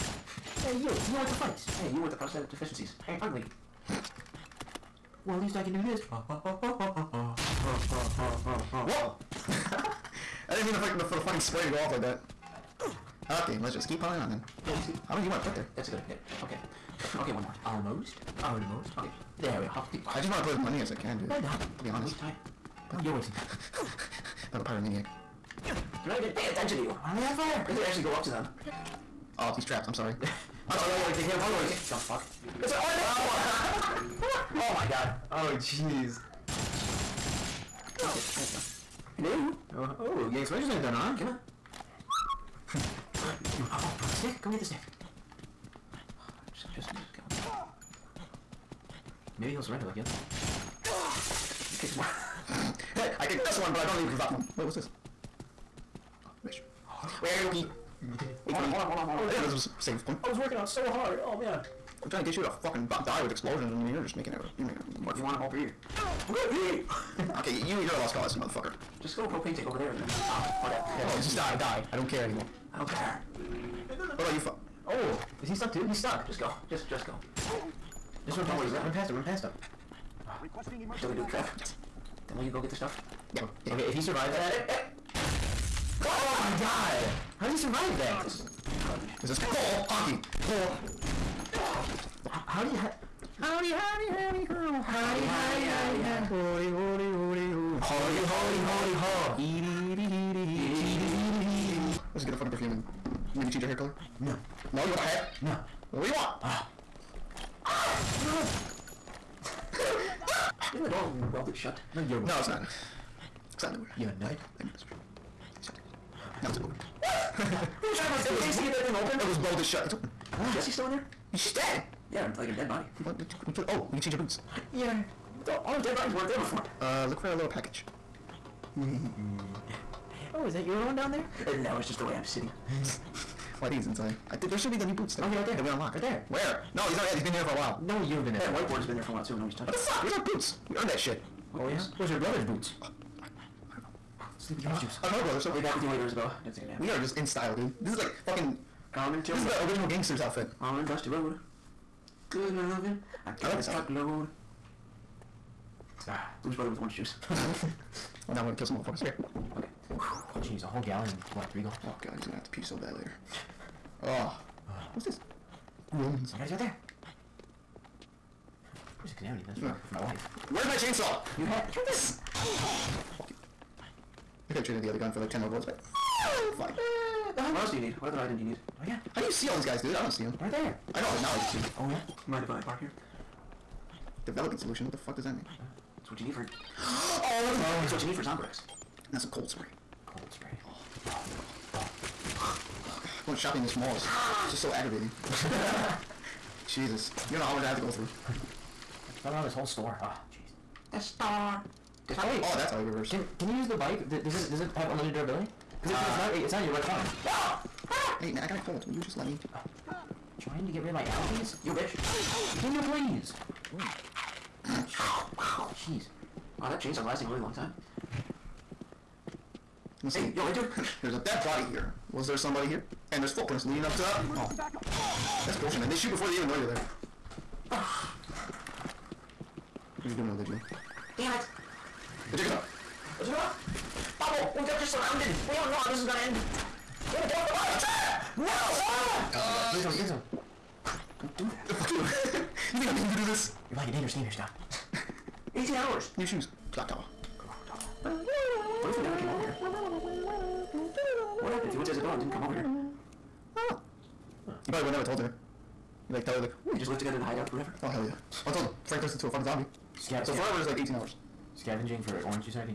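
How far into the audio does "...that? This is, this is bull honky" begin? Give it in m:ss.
1:27.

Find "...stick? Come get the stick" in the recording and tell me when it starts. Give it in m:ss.
0:44.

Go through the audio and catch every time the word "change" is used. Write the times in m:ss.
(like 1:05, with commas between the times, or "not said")
1:43, 2:04.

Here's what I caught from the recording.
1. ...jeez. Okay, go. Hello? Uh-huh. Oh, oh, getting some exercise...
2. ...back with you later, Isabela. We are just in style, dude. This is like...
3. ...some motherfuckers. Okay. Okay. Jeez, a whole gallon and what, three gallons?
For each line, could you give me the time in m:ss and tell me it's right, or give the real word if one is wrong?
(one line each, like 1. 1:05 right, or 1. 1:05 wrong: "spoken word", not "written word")
1. 0:35 right
2. 2:25 right
3. 2:38 right.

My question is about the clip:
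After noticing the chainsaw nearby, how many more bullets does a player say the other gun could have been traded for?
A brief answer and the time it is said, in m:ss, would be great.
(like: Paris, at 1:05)
10, at 2:55.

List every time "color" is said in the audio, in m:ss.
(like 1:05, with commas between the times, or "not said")
1:43.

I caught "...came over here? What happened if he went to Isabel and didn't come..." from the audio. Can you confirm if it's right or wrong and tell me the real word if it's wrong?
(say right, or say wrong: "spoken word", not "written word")
right.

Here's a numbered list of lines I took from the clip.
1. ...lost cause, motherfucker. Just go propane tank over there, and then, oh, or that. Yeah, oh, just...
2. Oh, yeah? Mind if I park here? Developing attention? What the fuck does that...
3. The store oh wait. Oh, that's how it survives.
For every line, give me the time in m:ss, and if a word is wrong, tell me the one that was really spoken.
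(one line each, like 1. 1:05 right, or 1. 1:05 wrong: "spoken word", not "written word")
1. 1:07 right
2. 3:01 wrong: "solution", not "attention"
3. 3:20 wrong: "reverses", not "survives".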